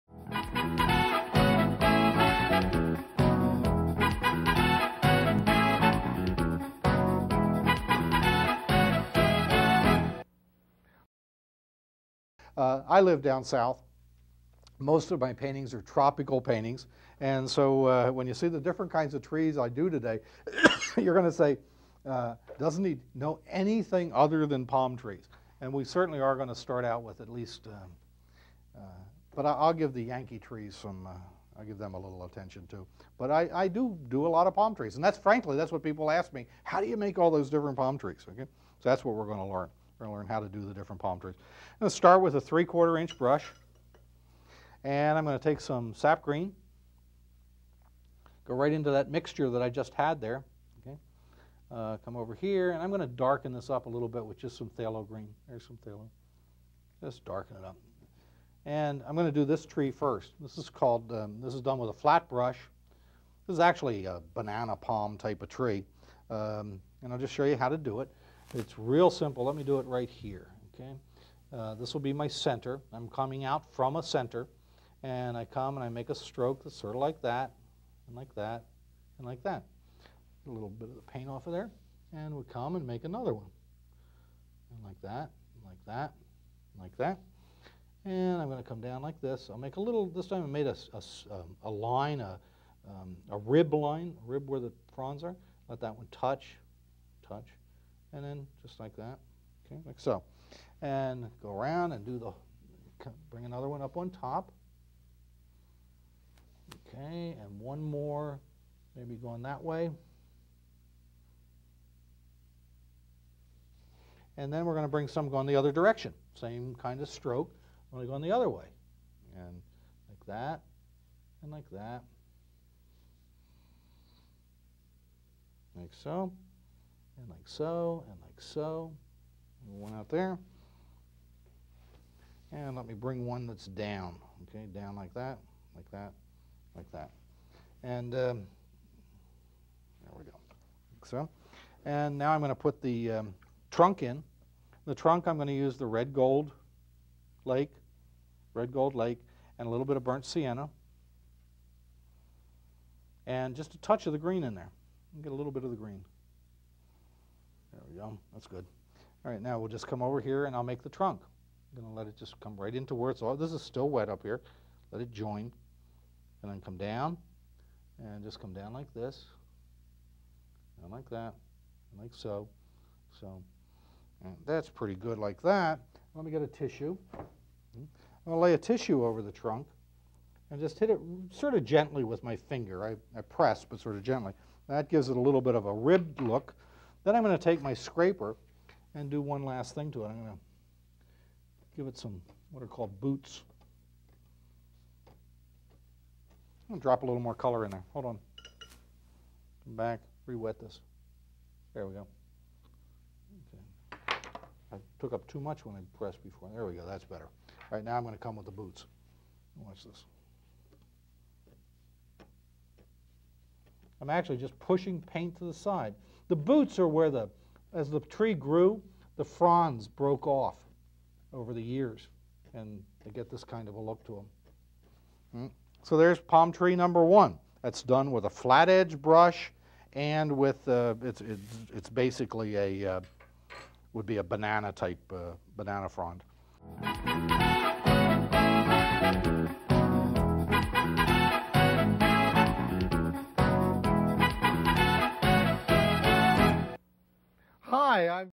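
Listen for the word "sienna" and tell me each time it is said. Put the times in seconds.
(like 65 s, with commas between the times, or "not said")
150 s.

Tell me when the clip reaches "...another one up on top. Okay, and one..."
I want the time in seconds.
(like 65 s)
103 s.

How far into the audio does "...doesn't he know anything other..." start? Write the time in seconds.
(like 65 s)
22 s.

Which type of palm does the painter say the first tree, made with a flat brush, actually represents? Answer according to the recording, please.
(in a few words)
banana palm.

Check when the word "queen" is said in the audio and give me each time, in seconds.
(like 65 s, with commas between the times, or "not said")
not said.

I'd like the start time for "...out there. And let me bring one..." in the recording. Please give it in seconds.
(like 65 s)
129 s.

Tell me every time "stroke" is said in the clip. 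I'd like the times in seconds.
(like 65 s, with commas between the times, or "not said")
76 s, 117 s.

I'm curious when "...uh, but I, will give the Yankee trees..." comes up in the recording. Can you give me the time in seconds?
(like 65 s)
28 s.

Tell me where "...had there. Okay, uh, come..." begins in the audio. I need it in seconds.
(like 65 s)
49 s.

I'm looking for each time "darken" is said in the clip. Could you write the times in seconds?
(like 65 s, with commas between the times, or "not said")
53 s, 57 s.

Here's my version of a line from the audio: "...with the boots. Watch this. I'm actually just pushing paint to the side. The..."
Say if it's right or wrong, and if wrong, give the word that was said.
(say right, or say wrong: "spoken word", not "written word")
right.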